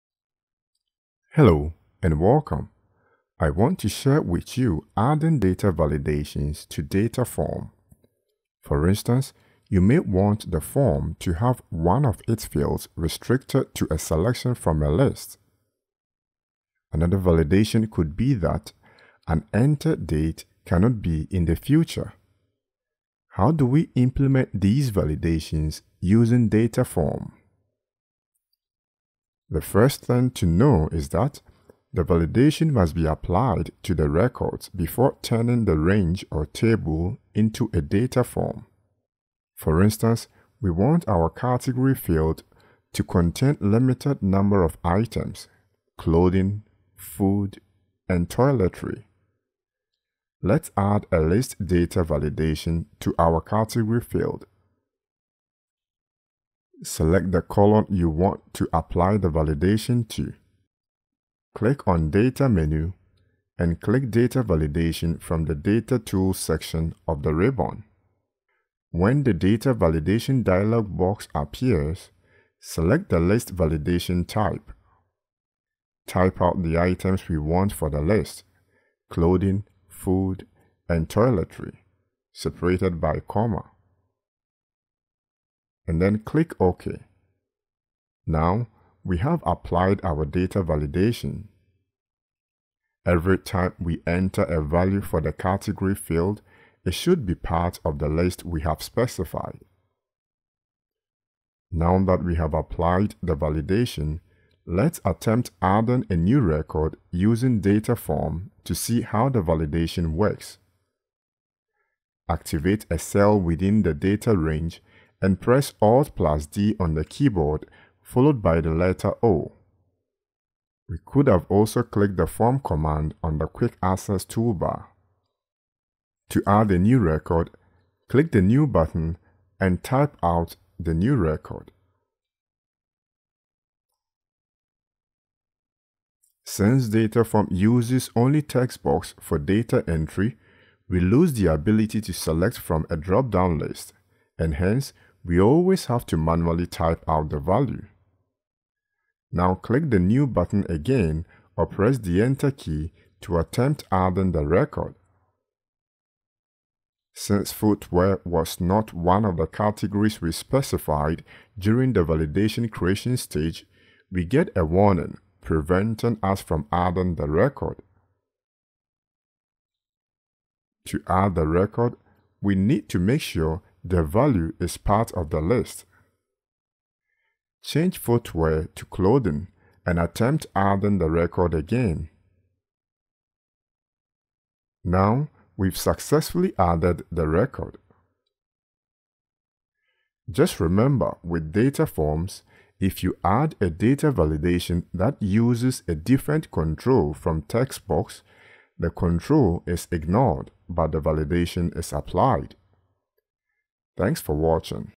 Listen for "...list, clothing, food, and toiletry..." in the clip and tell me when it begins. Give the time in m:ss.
1:18.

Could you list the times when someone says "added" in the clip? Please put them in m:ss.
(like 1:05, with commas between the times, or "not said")
3:06.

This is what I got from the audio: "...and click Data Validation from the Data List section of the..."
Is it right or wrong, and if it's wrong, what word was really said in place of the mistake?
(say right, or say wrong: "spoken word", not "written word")
wrong: "Tools", not "List".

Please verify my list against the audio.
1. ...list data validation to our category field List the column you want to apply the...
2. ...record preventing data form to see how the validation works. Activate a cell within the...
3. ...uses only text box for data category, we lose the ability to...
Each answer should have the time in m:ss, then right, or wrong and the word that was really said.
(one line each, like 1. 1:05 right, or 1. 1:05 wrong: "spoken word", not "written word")
1. 0:51 wrong: "Select", not "List"
2. 1:46 wrong: "using", not "preventing"
3. 2:17 wrong: "entry", not "category".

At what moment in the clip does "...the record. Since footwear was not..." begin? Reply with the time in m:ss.
2:34.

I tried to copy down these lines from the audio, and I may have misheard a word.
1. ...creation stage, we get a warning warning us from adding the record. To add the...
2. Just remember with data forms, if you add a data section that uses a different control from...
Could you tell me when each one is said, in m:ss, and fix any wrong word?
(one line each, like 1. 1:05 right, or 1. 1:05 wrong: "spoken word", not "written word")
1. 2:42 wrong: "preventing", not "warning"
2. 3:10 wrong: "validation", not "section".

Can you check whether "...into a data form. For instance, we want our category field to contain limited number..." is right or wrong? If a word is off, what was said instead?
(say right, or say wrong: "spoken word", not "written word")
right.